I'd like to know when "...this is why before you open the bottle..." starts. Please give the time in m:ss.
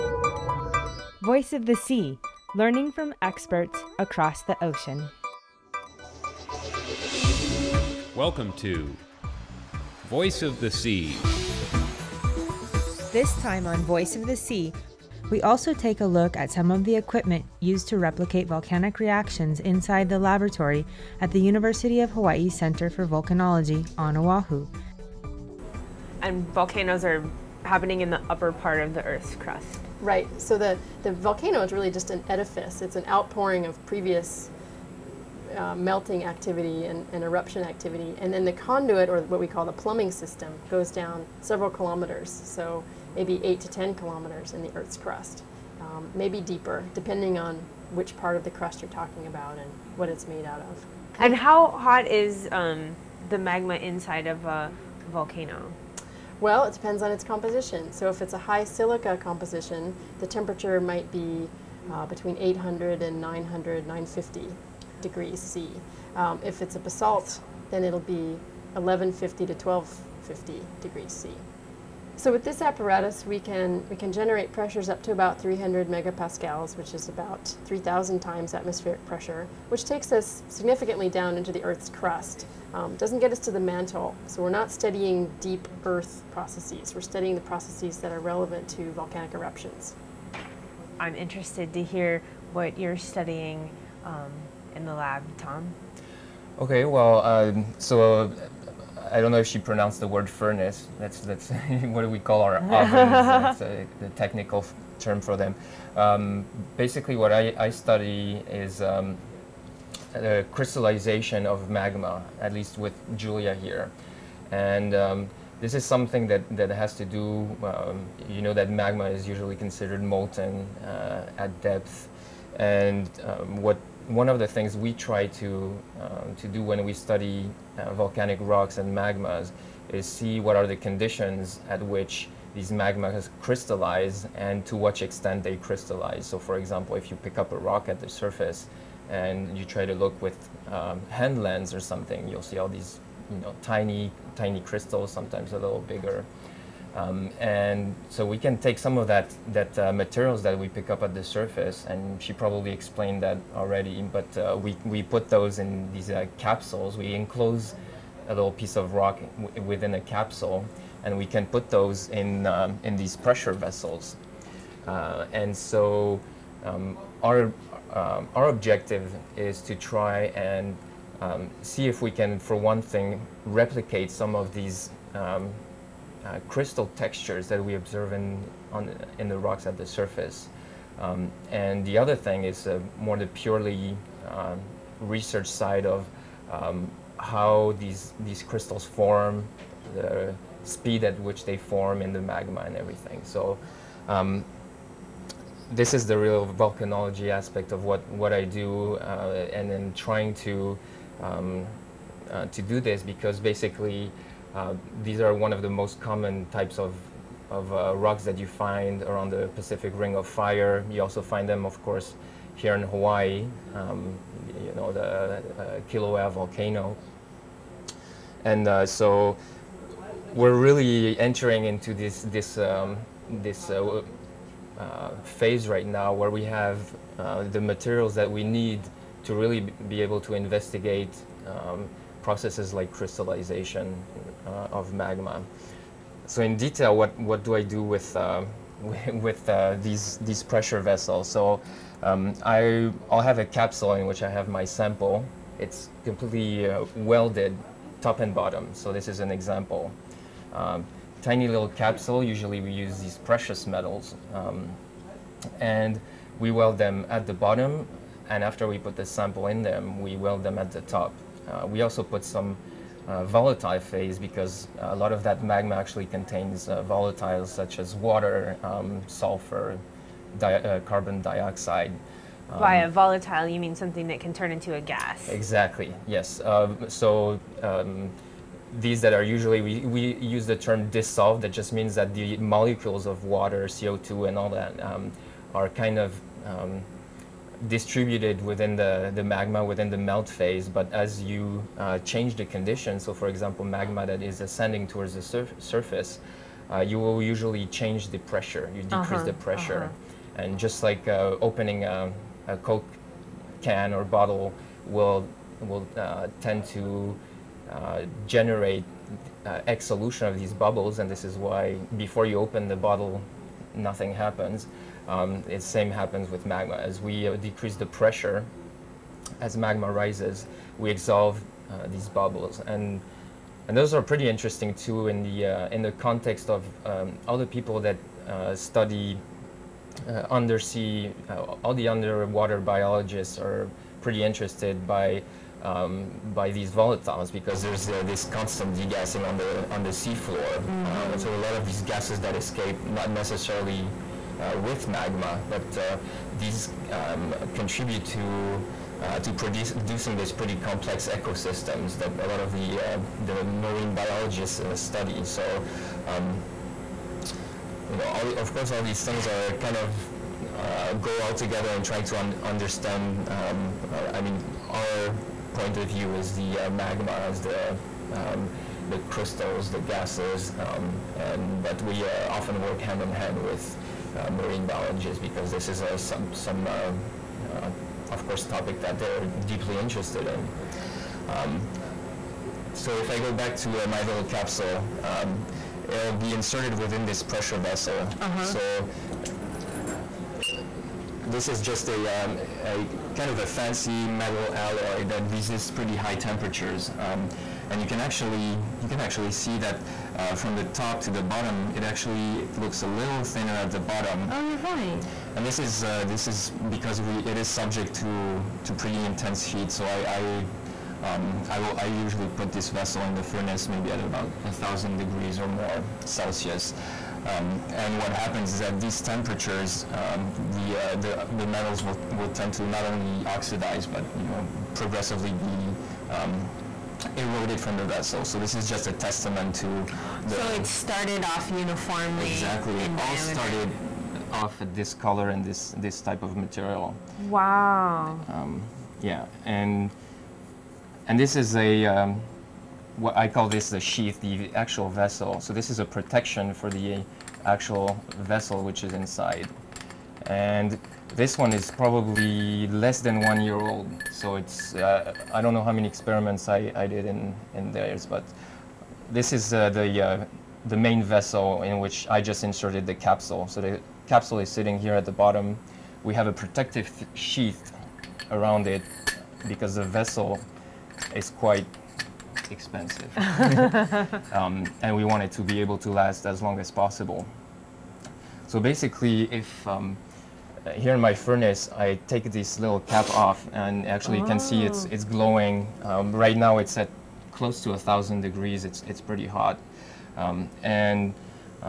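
5:11.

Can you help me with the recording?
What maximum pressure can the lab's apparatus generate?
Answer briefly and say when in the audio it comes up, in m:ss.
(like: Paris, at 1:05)
300 megapascals, at 1:15.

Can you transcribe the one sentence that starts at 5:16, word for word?
As we uh, decrease the pressure, as magma rises, we exsolve uh, these bubbles.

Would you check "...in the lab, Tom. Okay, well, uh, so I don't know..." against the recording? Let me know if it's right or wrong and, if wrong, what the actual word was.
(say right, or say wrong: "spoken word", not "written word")
right.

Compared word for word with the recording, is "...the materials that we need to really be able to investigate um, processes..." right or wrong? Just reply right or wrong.
right.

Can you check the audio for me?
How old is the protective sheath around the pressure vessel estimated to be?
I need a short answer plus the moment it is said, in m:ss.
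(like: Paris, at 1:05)
less than one year, at 7:32.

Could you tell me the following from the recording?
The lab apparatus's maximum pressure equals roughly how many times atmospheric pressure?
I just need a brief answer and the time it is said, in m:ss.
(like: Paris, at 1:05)
3,000, at 1:17.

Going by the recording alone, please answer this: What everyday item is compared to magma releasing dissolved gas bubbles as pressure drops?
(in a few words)
coke can.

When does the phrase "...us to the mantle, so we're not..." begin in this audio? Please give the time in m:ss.
1:23.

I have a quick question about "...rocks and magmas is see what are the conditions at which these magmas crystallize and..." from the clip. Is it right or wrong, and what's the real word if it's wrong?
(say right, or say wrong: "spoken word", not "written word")
right.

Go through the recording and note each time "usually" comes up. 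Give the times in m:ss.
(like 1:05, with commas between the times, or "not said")
1:59, 4:12, 4:39, 4:57, 6:51.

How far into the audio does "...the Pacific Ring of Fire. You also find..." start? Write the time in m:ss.
3:29.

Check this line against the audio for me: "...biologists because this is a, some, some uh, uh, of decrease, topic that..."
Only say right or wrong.
wrong.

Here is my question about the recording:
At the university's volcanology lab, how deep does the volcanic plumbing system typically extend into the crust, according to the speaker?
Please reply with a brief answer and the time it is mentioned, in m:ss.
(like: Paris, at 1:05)
8 to 10 kilometers, at 0:43.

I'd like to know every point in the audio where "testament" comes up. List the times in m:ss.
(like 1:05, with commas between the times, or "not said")
7:08.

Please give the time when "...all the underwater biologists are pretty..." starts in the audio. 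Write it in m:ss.
5:31.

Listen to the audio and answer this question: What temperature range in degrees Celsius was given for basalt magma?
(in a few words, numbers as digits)
1150 to 1250.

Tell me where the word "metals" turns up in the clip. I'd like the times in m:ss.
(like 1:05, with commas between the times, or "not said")
4:13, 6:34, 7:01.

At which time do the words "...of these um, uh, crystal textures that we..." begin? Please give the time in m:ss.
2:54.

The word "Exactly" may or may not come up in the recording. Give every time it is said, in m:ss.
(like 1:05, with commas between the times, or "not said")
4:35, 7:12.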